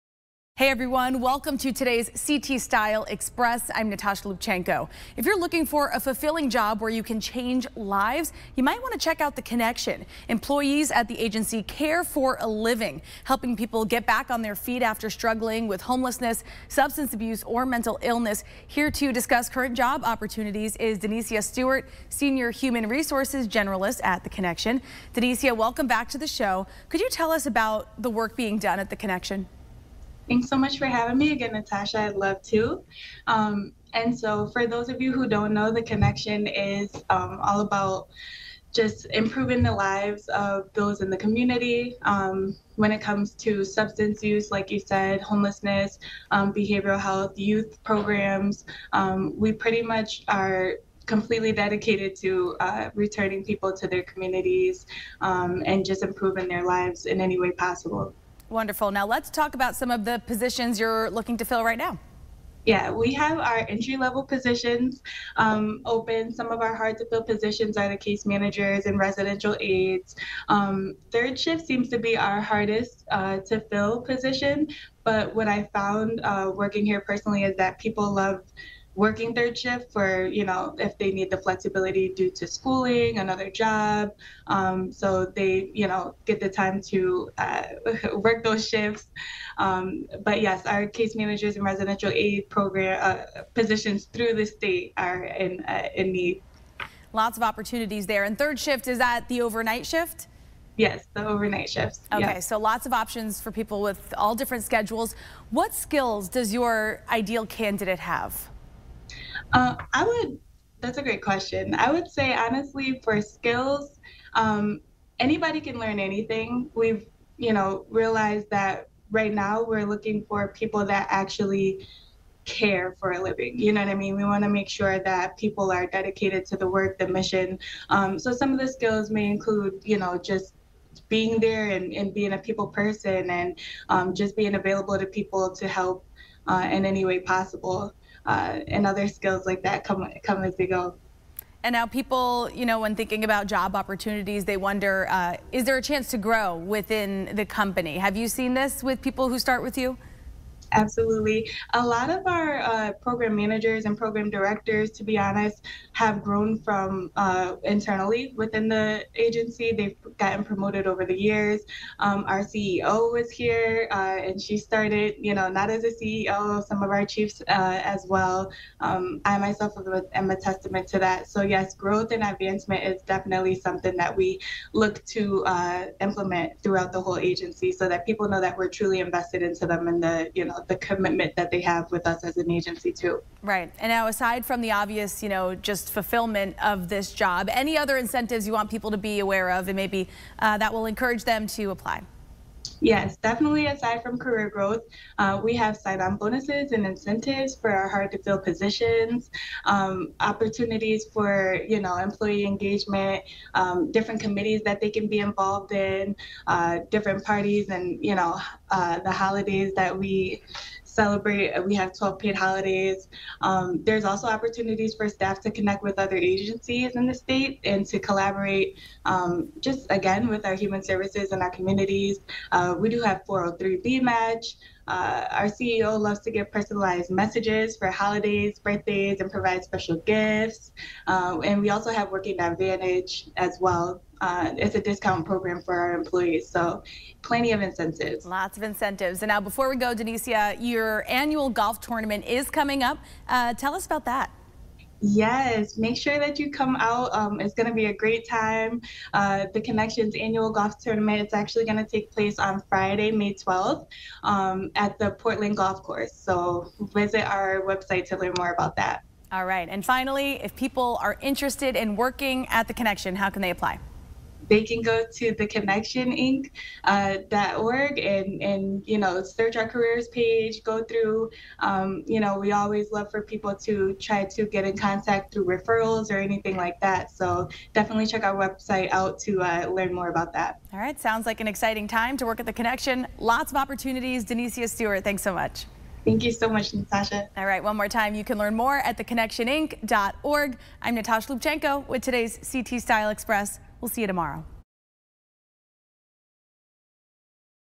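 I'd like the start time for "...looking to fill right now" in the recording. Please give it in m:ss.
1:01.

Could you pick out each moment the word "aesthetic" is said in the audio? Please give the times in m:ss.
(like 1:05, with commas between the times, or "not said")
not said.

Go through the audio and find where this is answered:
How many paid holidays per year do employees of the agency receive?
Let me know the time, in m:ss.
3:31.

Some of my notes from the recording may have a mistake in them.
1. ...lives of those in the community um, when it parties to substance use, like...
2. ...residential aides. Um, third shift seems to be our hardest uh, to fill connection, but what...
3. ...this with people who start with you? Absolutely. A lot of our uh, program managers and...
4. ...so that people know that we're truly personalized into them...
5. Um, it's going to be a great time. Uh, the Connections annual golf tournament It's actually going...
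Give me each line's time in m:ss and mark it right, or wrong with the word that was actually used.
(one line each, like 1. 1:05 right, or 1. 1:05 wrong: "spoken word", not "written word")
1. 0:39 wrong: "comes", not "parties"
2. 1:08 wrong: "position", not "connection"
3. 2:28 right
4. 2:57 wrong: "invested", not "personalized"
5. 4:07 right.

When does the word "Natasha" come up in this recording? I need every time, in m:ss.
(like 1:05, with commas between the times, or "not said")
0:03, 0:31, 4:46, 4:50.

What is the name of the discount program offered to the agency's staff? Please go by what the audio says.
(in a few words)
Working Advantage.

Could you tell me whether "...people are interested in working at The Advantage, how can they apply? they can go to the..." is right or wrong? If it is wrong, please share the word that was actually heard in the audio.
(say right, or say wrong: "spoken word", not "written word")
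wrong: "Connection", not "Advantage".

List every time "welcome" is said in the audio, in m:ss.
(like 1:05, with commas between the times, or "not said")
0:01, 0:25.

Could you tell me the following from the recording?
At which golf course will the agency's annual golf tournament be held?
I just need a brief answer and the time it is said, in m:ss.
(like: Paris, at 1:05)
Portland Golf Course, at 4:15.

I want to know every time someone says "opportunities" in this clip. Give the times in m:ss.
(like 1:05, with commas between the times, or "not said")
0:20, 1:37, 2:23, 3:20, 3:34, 4:43.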